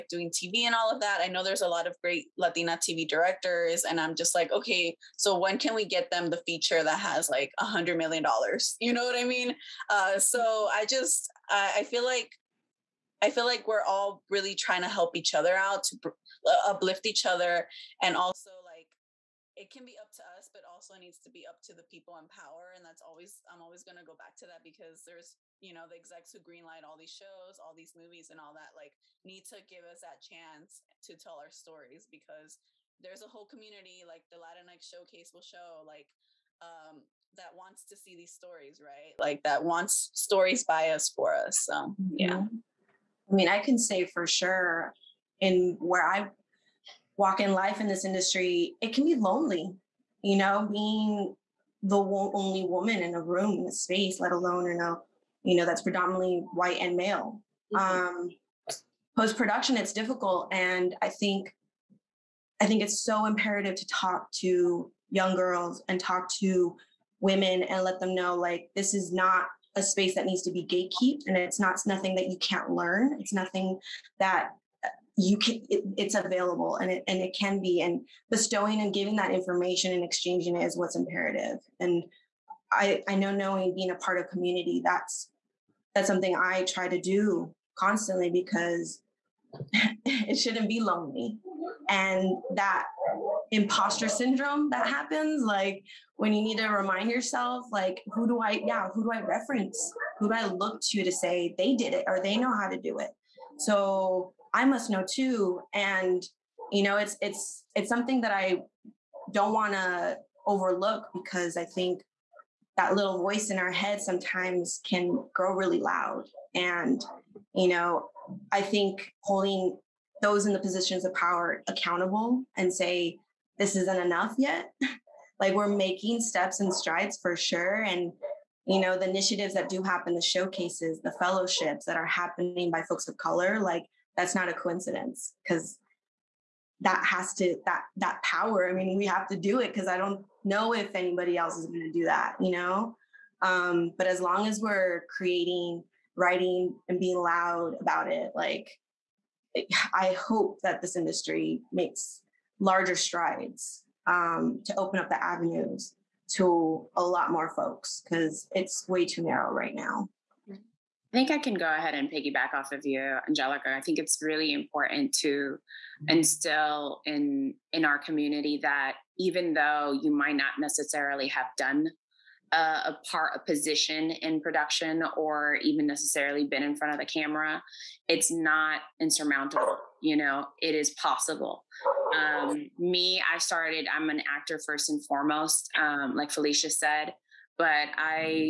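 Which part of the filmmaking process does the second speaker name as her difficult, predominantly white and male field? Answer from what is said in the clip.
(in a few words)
Post production.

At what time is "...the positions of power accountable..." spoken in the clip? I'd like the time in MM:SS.
02:00.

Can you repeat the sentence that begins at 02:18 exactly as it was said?
I mean, we have to do it because I don't know if anybody else is going to do that, you know.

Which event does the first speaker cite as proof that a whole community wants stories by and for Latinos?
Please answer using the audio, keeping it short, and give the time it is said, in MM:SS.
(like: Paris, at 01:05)
Latinx Showcase, at 00:34.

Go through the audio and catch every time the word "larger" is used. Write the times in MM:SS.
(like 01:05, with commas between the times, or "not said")
02:32.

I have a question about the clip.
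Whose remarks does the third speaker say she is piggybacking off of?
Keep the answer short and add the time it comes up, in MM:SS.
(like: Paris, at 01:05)
Angelica, at 02:43.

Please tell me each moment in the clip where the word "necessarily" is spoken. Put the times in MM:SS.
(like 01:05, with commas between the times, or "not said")
02:50, 02:55.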